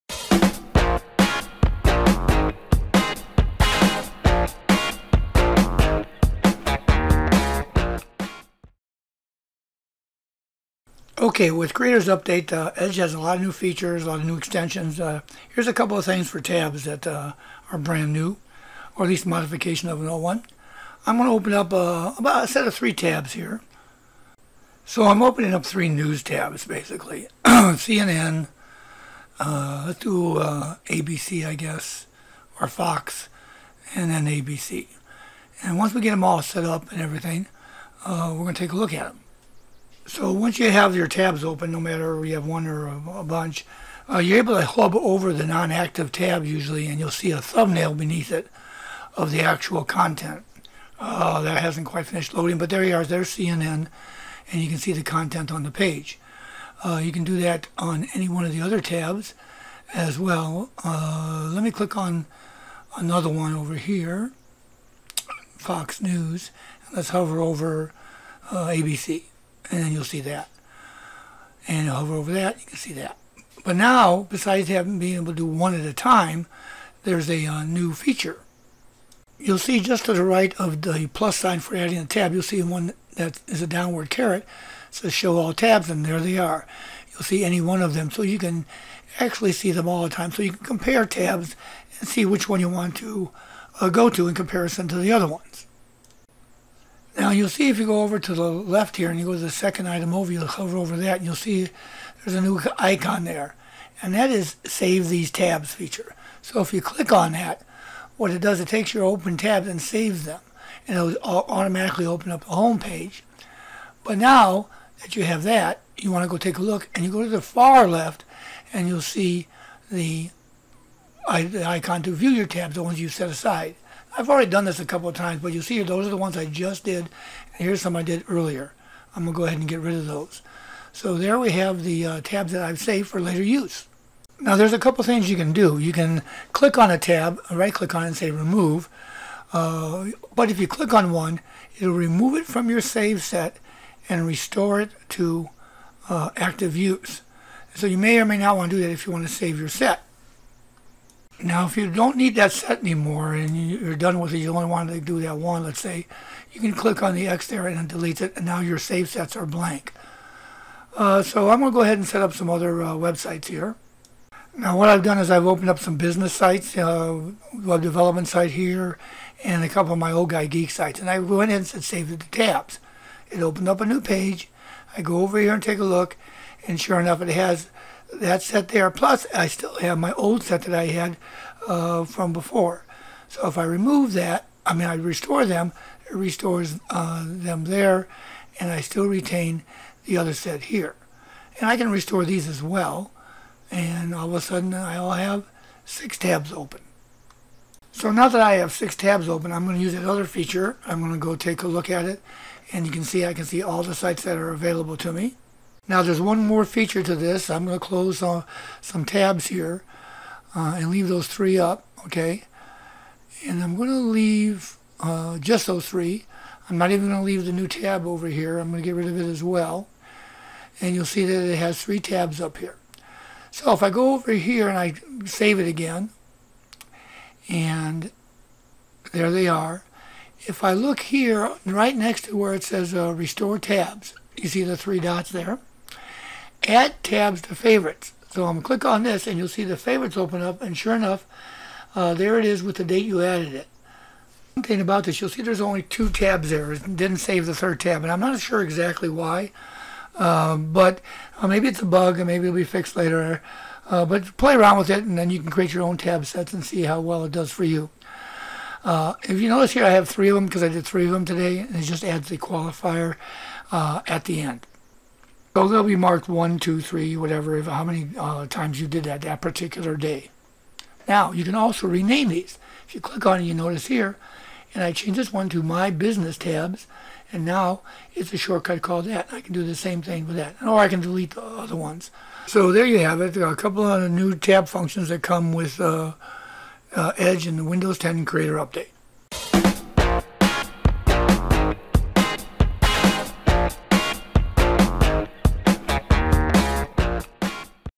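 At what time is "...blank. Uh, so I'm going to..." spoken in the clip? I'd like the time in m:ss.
2:39.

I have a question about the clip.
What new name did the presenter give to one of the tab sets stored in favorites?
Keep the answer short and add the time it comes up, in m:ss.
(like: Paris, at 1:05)
My Business tabs, at 4:35.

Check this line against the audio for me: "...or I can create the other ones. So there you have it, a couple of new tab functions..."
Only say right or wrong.
wrong.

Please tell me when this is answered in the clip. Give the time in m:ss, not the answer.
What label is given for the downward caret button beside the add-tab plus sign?
1:25.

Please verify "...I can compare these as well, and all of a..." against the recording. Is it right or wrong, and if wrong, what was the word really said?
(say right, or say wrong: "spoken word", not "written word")
wrong: "restore", not "compare".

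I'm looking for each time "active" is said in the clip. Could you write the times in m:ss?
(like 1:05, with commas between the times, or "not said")
0:45, 2:26.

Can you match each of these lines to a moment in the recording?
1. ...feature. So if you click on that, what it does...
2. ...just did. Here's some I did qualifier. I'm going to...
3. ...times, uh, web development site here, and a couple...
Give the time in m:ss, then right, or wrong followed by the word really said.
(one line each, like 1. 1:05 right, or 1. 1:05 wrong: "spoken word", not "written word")
1. 1:45 right
2. 2:06 wrong: "earlier", not "qualifier"
3. 2:46 wrong: "sites", not "times".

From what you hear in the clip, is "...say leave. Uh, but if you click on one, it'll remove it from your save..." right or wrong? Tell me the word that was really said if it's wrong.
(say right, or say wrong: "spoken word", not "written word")
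wrong: "remove", not "leave".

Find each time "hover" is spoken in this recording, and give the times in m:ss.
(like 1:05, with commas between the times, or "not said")
0:44, 1:07, 1:11, 1:40.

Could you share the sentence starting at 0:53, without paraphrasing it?
There's CNN, and you can see the content on the page.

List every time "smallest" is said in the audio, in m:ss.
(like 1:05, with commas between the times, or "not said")
not said.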